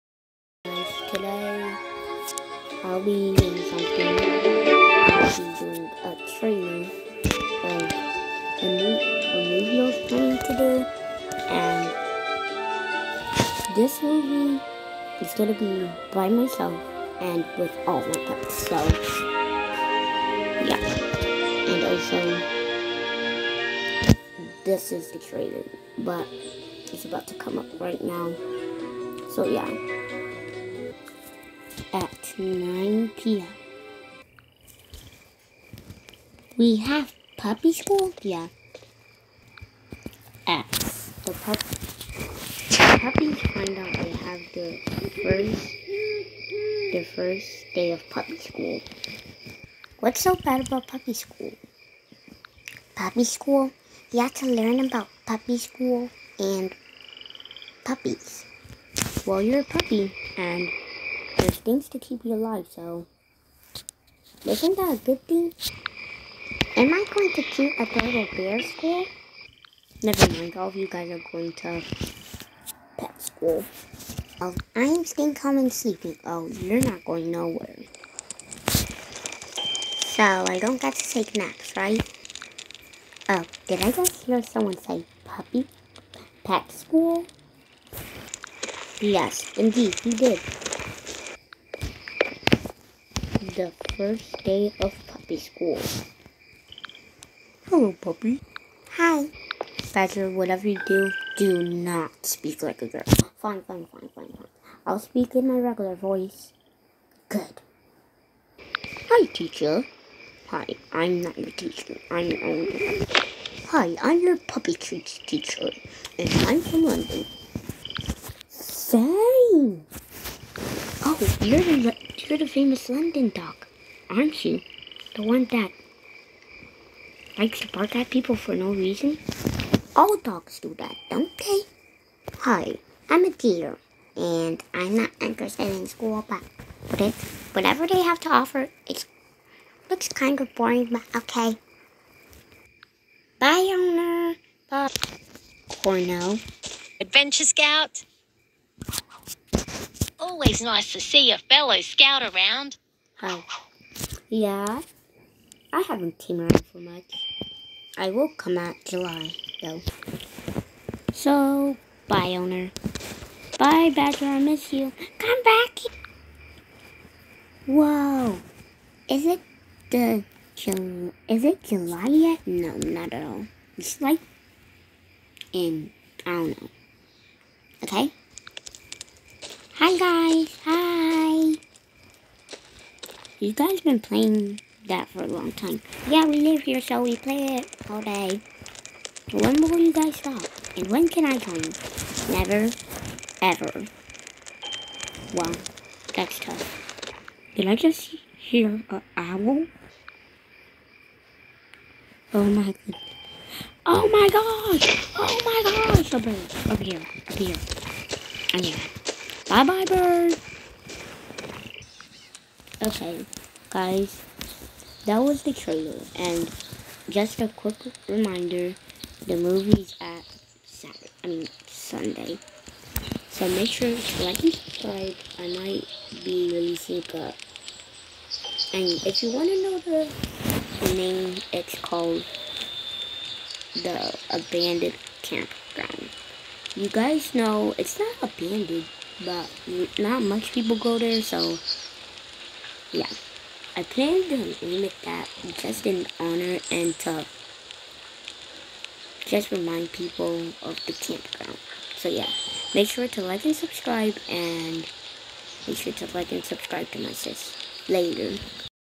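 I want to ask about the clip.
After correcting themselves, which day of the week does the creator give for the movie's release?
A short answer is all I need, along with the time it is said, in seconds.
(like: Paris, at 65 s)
Sunday, at 221 s.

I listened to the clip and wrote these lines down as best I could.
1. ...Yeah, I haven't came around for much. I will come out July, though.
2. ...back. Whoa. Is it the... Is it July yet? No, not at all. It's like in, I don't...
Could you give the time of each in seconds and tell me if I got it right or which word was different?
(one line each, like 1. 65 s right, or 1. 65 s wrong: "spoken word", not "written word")
1. 154 s right
2. 165 s right.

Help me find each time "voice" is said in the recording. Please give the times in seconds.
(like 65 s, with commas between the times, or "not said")
105 s.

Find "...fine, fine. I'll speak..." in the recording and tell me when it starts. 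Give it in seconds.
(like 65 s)
104 s.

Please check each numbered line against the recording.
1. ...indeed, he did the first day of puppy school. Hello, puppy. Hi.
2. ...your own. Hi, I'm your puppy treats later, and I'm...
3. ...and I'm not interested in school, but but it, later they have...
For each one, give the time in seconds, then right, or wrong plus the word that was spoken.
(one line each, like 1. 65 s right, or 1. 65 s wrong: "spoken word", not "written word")
1. 89 s right
2. 112 s wrong: "teacher", not "later"
3. 134 s wrong: "whatever", not "later".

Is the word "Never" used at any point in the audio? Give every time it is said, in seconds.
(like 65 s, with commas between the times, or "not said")
70 s, 192 s.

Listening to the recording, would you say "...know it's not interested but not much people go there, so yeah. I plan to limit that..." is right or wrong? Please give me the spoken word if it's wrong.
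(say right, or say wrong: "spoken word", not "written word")
wrong: "abandoned", not "interested".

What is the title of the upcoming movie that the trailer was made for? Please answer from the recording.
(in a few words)
The Abandoned Campground.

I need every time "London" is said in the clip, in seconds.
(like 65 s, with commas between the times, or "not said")
116 s, 122 s.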